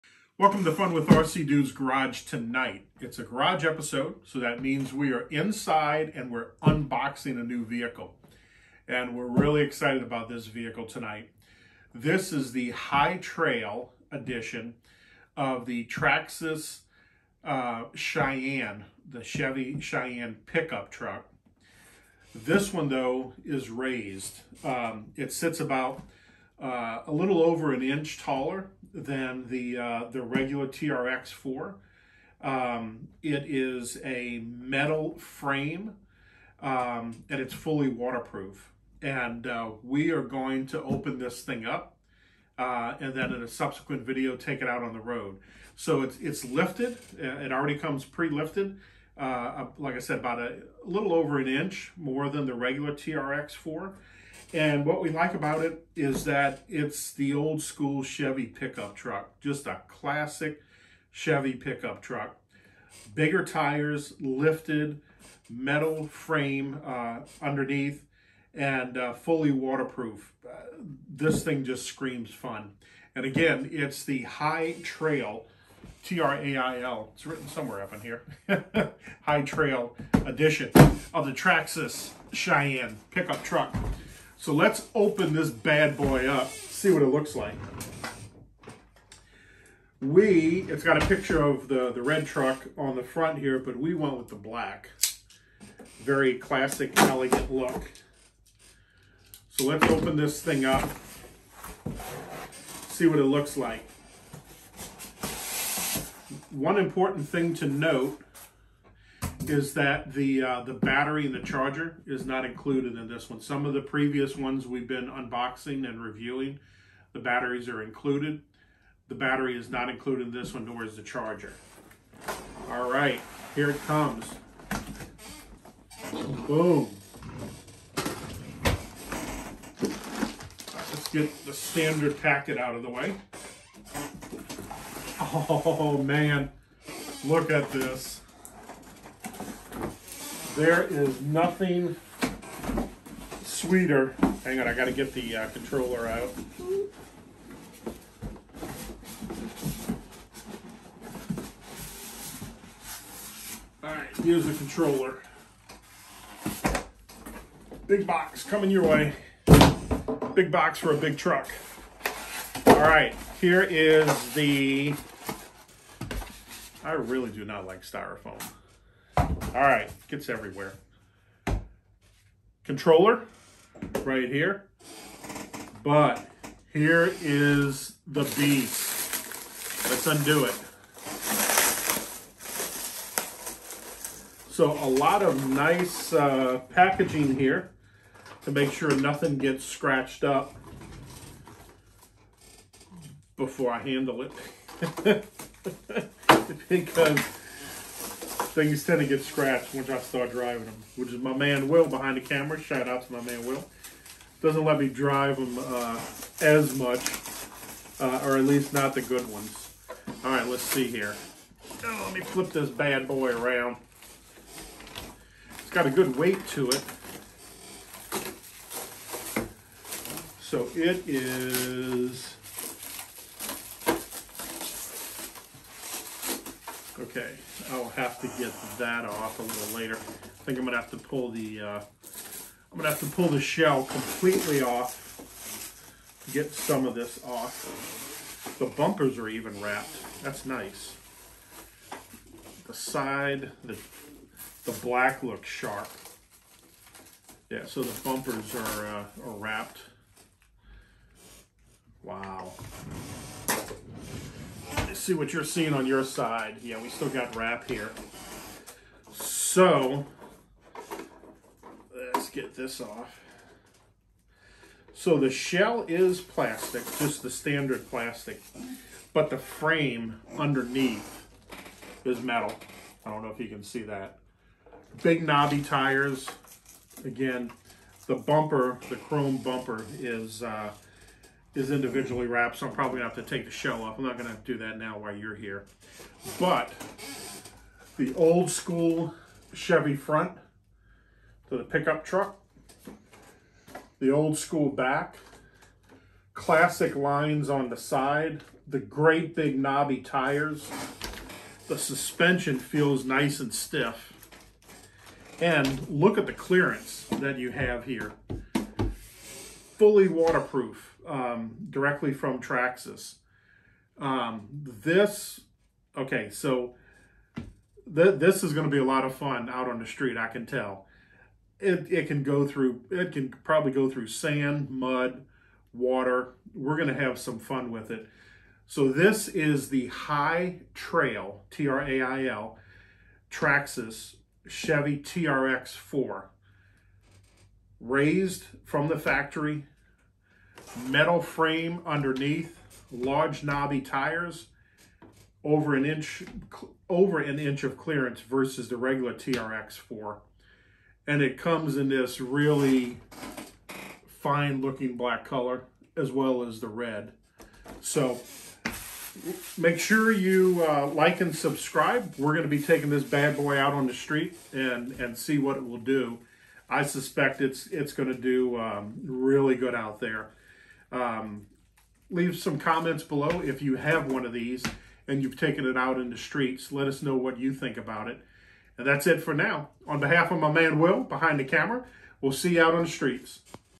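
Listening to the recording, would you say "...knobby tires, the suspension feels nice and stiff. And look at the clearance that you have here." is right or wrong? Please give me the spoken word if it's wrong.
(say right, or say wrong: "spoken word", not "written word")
right.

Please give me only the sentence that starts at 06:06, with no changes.
I suspect it's, it's going to do um, really good out there.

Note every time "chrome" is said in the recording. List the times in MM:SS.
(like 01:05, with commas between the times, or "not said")
04:38.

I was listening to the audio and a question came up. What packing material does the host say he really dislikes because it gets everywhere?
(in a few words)
Styrofoam.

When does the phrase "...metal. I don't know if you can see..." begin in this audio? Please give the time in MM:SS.
04:32.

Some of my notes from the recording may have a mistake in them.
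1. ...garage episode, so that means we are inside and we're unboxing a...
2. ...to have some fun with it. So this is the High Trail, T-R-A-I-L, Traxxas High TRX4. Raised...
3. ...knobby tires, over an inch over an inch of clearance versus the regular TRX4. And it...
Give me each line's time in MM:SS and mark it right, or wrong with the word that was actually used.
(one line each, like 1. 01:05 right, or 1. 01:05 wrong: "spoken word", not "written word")
1. 00:03 right
2. 05:26 wrong: "Chevy", not "High"
3. 05:43 right.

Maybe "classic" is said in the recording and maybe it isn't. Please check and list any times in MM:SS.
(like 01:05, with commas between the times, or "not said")
00:59, 01:36, 04:56.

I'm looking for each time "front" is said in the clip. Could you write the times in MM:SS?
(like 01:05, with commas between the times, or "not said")
01:33, 04:49.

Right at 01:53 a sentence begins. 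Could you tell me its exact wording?
Some of the previous ones we've been unboxing and reviewing, the batteries are included.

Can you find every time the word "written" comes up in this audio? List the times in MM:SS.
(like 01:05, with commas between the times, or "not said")
01:17.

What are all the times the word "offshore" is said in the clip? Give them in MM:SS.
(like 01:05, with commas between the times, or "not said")
not said.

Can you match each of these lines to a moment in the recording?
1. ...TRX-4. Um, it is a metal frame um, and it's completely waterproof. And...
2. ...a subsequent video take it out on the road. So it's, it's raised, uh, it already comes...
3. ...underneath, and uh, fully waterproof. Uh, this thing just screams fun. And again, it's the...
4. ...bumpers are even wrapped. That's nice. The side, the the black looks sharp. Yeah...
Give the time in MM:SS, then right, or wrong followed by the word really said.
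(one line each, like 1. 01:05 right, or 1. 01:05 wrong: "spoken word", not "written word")
1. 00:30 wrong: "fully", not "completely"
2. 00:43 wrong: "lifted", not "raised"
3. 01:07 right
4. 03:58 right.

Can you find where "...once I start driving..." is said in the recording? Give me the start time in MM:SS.
03:19.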